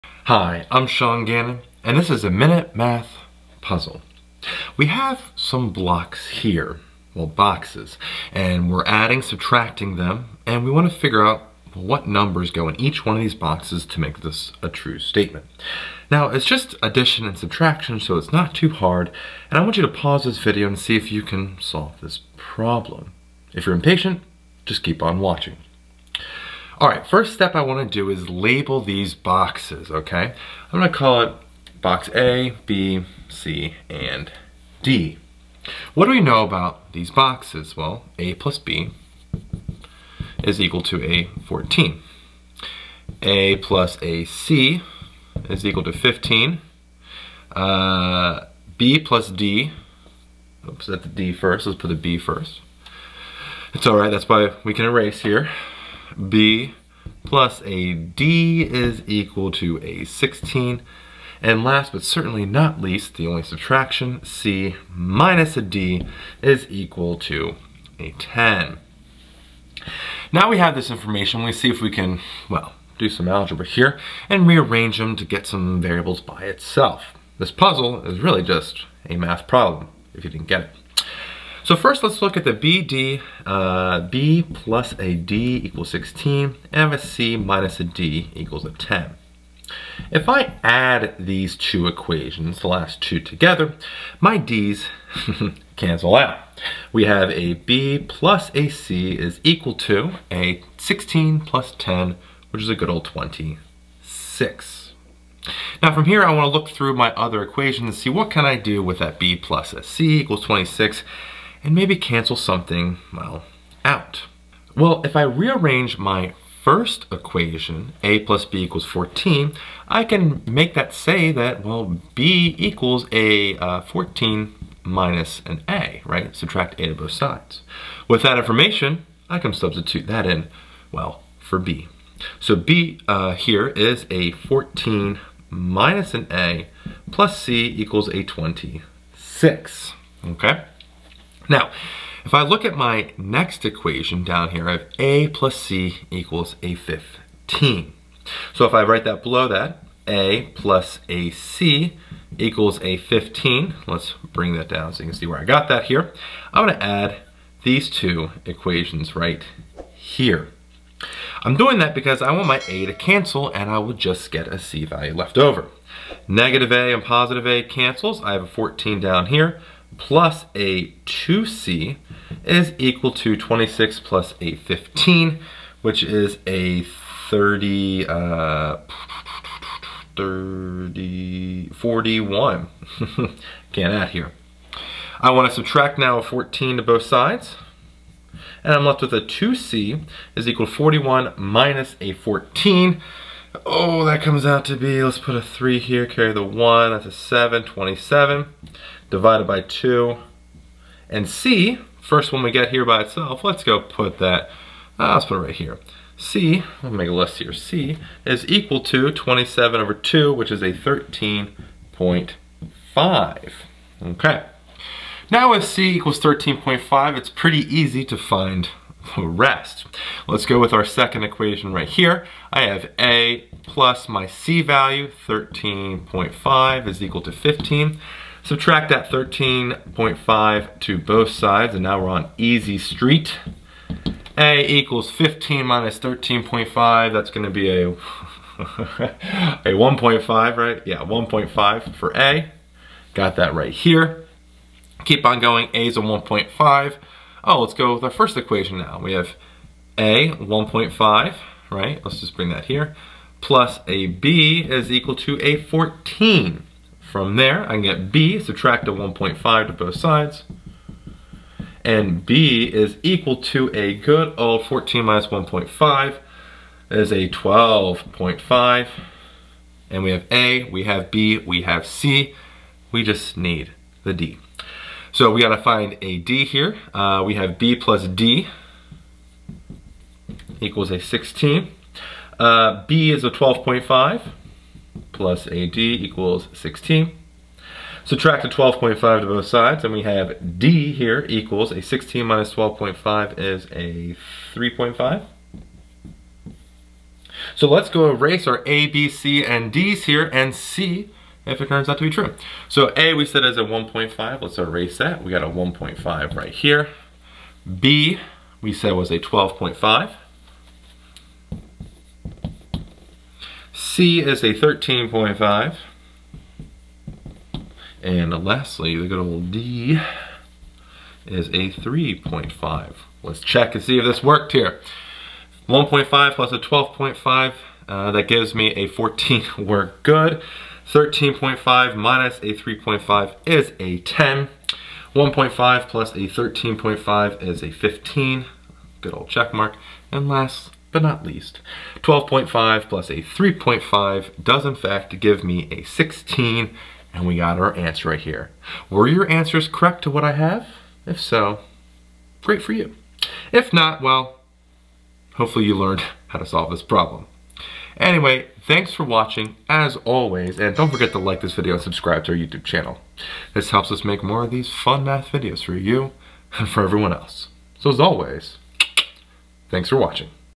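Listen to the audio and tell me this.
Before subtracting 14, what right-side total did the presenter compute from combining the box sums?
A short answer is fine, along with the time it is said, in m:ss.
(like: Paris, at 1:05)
41, at 3:00.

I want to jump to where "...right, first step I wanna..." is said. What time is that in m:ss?
0:26.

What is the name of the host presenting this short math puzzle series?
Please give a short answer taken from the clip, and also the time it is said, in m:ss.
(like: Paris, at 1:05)
Sean Gannon, at 0:00.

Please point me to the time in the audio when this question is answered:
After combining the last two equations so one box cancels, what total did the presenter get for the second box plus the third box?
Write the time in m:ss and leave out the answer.
1:42.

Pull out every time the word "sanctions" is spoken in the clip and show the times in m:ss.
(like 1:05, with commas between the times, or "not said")
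not said.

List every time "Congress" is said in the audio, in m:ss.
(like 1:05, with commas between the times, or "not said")
not said.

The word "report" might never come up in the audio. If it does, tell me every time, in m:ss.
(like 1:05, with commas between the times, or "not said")
not said.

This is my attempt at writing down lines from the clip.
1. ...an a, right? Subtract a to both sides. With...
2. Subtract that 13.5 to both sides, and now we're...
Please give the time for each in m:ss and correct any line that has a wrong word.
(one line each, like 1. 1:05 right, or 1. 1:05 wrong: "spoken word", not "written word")
1. 2:05 right
2. 3:48 right.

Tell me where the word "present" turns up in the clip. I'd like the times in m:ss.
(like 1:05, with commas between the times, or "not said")
not said.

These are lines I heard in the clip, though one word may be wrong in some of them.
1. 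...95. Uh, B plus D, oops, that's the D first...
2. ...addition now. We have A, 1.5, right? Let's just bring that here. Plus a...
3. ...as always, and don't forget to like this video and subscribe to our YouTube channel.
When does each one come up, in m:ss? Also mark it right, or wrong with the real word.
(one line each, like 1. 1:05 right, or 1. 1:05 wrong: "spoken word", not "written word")
1. 0:45 wrong: "15", not "95"
2. 4:08 wrong: "equation", not "addition"
3. 5:59 right.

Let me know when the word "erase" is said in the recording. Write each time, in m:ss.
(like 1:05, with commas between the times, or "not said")
0:54, 4:58, 5:04.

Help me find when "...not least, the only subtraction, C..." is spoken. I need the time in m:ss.
1:02.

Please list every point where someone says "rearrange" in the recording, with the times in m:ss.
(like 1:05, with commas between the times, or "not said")
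1:14, 1:55.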